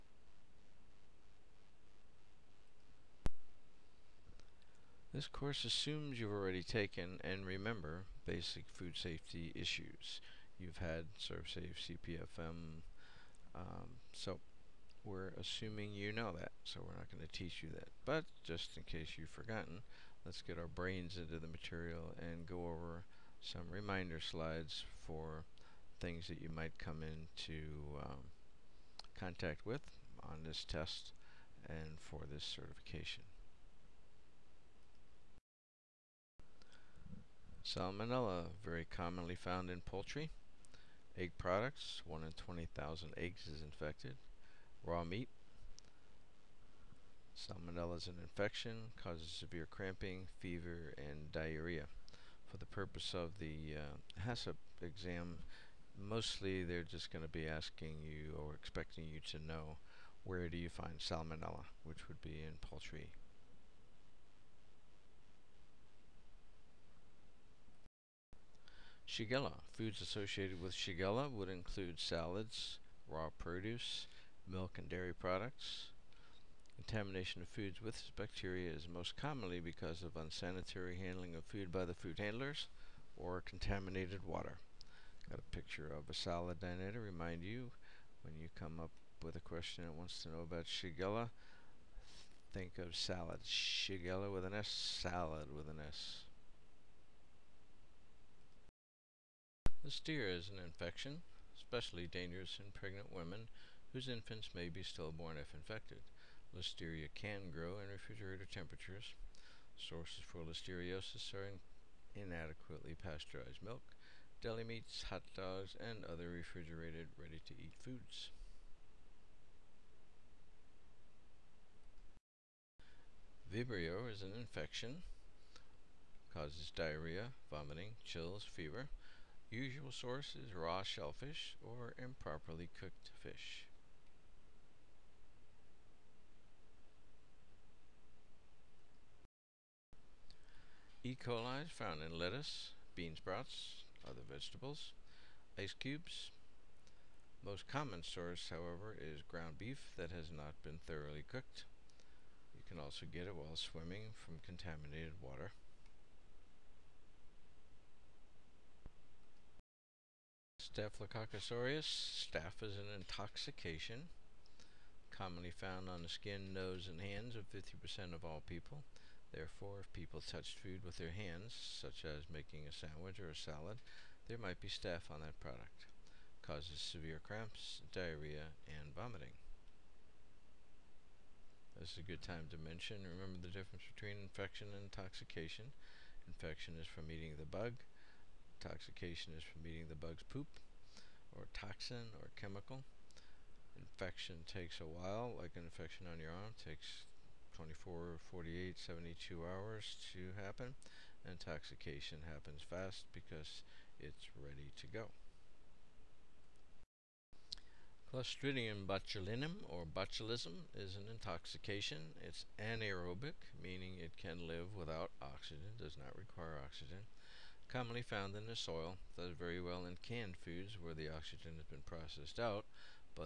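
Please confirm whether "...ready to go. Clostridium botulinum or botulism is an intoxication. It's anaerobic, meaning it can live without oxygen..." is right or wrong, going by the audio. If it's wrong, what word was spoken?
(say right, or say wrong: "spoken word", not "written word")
right.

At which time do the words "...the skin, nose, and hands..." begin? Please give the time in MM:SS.
02:46.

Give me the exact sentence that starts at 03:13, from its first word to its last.
Infection takes a while, like an infection on your arm, takes 24, 48, 72 hours to happen.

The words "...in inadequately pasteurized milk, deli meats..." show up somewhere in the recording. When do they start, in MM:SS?
01:51.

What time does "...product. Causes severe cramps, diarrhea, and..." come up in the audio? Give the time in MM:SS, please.
02:55.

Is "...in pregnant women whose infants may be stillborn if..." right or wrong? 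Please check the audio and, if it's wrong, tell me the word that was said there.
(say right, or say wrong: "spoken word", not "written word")
right.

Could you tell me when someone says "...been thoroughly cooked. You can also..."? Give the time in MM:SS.
02:30.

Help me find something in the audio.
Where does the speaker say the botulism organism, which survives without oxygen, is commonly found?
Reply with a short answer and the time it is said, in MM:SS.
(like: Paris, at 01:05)
in the soil, at 03:38.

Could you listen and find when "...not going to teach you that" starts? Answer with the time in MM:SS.
00:16.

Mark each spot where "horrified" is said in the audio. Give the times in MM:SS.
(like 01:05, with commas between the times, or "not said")
not said.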